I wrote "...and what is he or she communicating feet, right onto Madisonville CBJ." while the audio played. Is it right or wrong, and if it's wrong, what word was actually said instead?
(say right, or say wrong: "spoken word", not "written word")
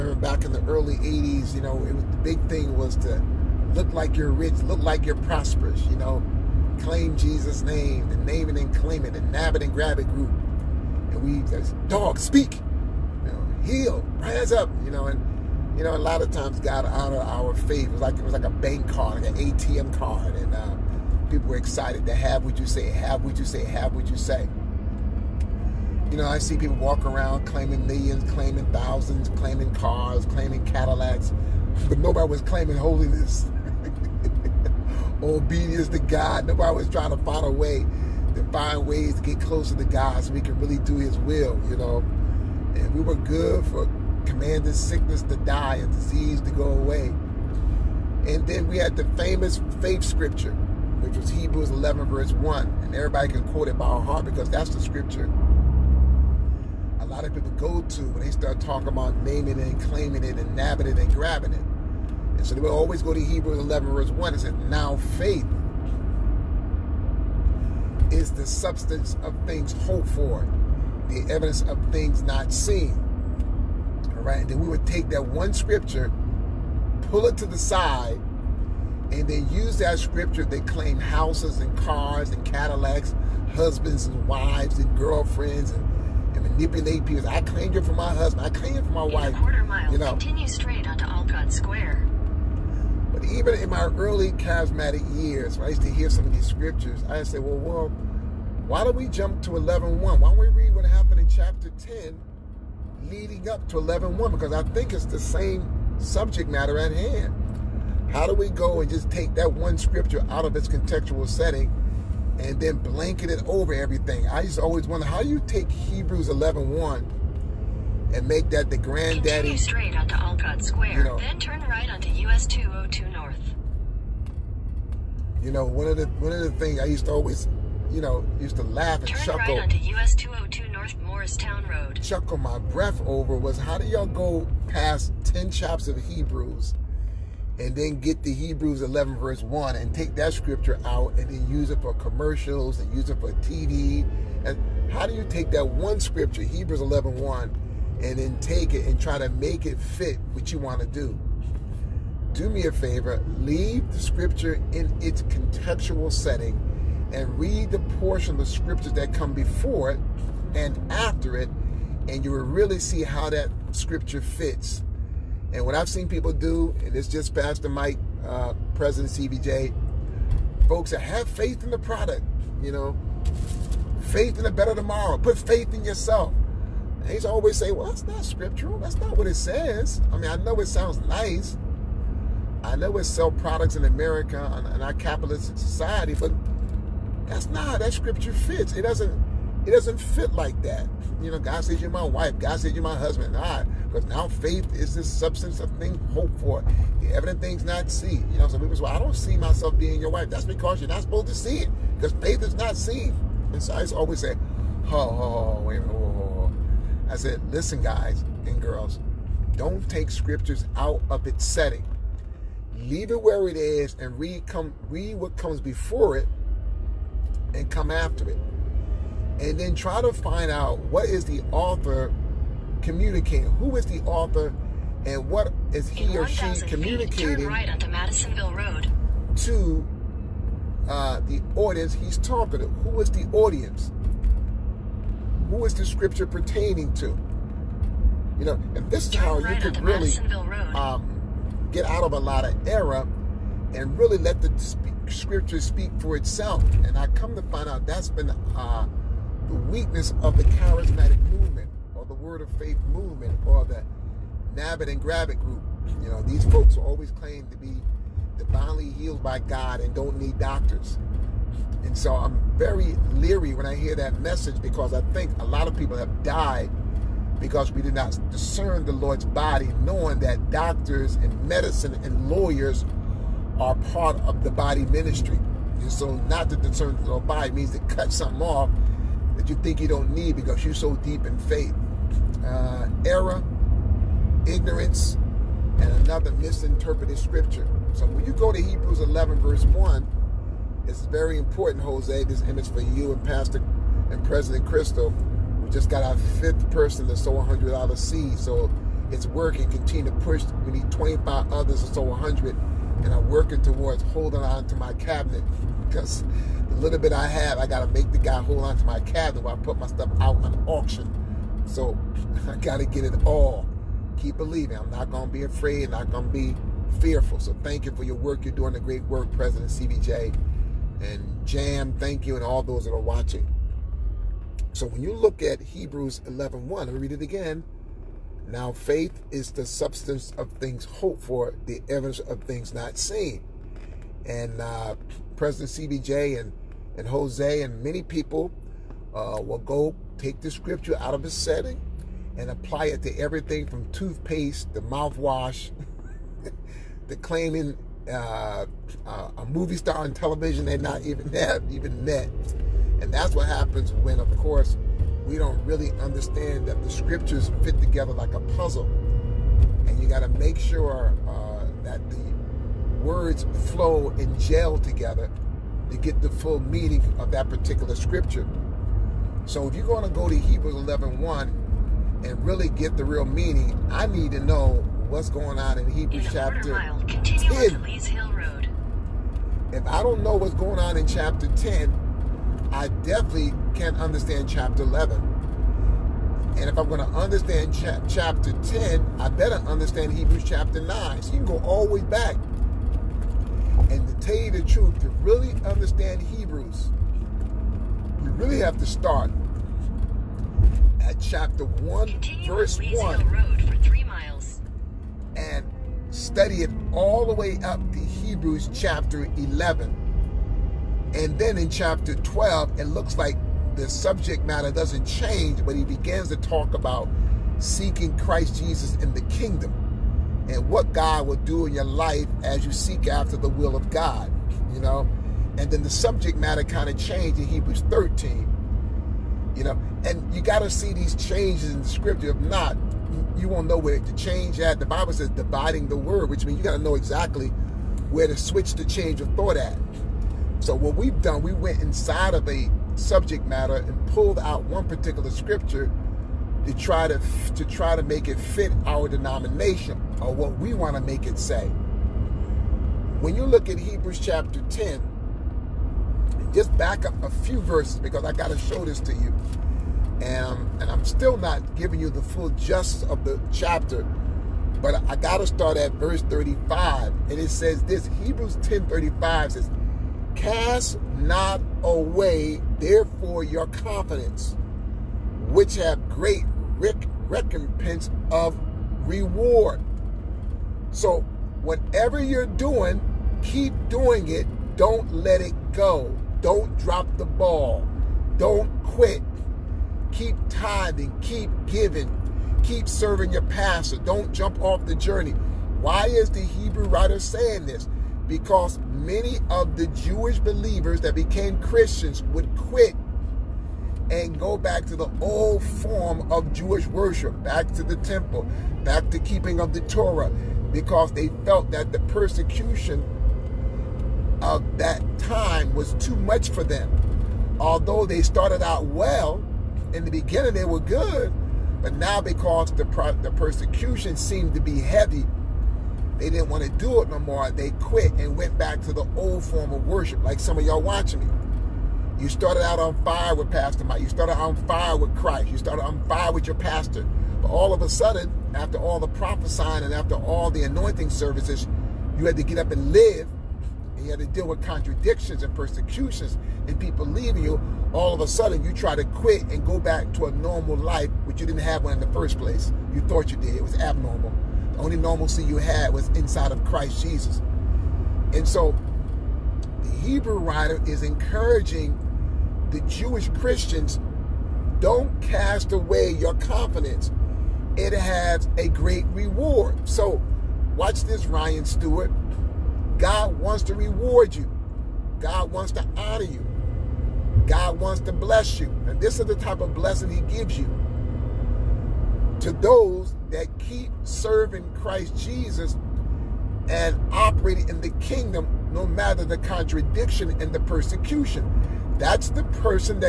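wrong: "Road", not "CBJ".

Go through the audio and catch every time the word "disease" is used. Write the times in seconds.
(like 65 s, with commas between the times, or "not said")
45 s.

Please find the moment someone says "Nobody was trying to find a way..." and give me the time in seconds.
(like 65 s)
36 s.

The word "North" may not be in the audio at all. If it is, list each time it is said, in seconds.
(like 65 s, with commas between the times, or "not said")
123 s, 130 s.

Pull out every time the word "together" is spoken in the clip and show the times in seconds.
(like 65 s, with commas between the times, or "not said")
357 s, 364 s.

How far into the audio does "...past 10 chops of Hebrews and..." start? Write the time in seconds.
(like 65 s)
134 s.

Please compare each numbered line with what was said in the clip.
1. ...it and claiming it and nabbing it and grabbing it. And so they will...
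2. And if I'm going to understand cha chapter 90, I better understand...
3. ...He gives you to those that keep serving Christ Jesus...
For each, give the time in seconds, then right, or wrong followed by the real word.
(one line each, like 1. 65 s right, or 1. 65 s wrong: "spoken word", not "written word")
1. 59 s right
2. 386 s wrong: "10", not "90"
3. 580 s right.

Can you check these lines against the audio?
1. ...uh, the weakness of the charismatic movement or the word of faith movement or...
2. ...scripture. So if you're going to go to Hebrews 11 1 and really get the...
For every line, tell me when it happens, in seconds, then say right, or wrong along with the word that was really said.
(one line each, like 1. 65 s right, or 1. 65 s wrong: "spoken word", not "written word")
1. 248 s right
2. 367 s right.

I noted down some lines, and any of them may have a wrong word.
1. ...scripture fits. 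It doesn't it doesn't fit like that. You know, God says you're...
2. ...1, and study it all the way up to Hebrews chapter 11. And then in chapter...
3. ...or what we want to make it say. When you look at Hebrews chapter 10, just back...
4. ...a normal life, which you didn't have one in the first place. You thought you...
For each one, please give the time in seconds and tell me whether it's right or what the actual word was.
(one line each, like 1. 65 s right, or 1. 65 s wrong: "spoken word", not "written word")
1. 187 s right
2. 402 s right
3. 450 s right
4. 550 s right.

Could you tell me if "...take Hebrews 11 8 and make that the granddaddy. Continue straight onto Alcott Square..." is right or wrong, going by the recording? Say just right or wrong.
wrong.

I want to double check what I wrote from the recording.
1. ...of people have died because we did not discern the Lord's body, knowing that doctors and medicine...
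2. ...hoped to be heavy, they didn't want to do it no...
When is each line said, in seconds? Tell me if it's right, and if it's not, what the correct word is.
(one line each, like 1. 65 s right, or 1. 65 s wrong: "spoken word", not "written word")
1. 265 s right
2. 524 s wrong: "seemed", not "hoped".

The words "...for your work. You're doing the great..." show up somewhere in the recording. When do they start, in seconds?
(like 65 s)
317 s.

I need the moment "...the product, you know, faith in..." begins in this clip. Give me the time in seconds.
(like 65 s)
171 s.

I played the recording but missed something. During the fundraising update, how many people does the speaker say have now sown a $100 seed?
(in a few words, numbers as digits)
5.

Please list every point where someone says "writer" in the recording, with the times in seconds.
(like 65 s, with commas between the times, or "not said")
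496 s, 560 s.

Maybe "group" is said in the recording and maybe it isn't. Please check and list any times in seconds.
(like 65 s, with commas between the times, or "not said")
10 s, 255 s.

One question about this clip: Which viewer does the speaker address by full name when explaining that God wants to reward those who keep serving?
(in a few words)
Ryan Stewart.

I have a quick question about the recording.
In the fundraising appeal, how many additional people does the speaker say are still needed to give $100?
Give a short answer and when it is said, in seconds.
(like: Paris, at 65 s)
25, at 300 s.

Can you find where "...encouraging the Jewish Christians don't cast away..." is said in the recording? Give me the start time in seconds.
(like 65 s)
561 s.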